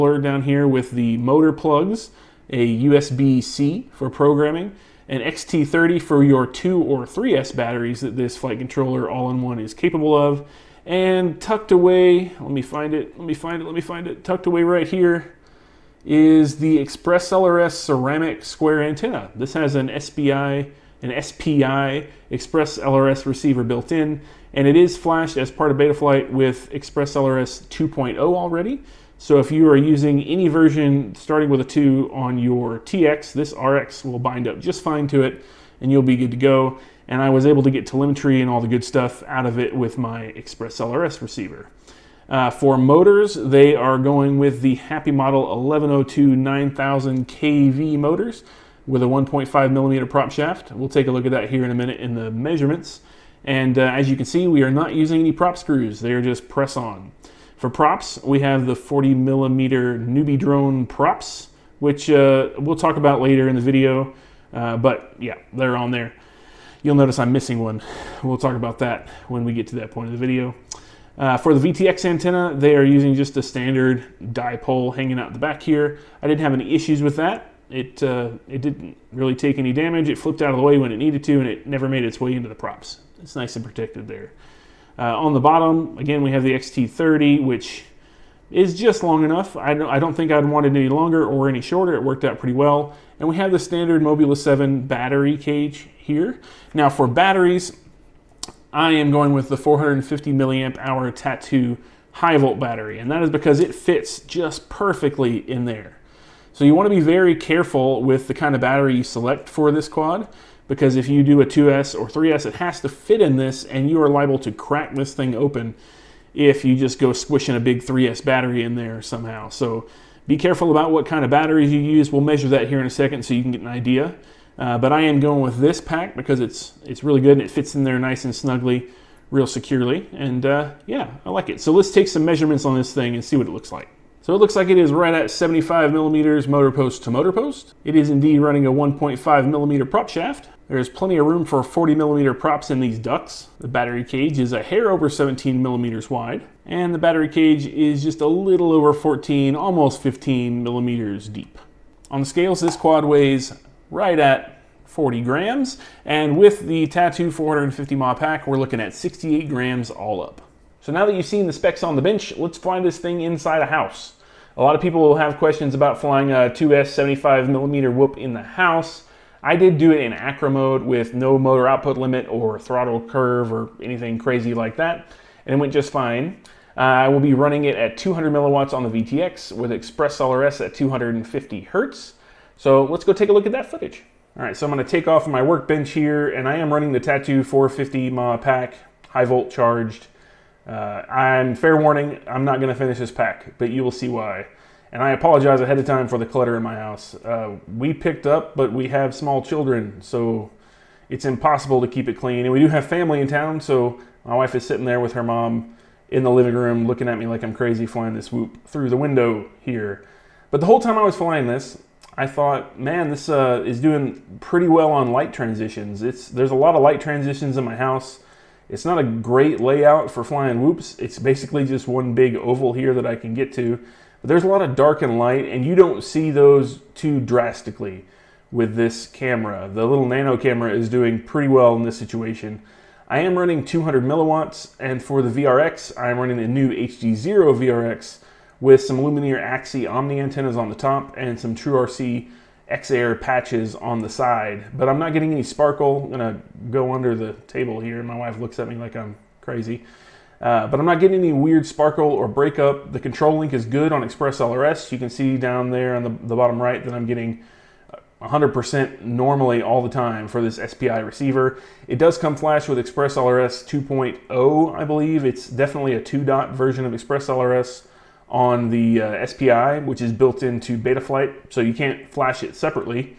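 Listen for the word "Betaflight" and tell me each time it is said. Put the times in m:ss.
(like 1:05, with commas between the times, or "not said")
0:25, 4:30.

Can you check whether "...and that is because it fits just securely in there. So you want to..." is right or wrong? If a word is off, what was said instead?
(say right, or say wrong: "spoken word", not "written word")
wrong: "perfectly", not "securely".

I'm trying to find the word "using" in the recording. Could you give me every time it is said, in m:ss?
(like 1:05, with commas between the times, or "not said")
0:29, 0:54, 1:12.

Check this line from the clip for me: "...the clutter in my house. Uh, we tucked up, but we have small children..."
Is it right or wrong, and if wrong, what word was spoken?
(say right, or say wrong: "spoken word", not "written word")
wrong: "picked", not "tucked".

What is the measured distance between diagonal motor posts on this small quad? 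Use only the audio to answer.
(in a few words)
75 millimeters.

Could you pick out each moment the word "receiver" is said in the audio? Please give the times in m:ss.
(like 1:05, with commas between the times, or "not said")
0:23, 0:41, 4:20.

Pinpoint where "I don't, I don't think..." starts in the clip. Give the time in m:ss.
1:29.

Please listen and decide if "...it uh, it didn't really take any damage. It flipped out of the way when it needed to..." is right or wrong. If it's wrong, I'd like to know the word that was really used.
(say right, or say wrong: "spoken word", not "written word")
right.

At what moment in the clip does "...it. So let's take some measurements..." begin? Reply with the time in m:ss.
2:11.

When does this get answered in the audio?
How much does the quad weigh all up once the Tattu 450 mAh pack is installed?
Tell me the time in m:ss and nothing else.
2:38.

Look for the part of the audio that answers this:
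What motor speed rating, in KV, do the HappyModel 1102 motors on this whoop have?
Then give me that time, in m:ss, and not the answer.
0:46.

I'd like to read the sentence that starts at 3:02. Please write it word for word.
So let's go take a look at that footage.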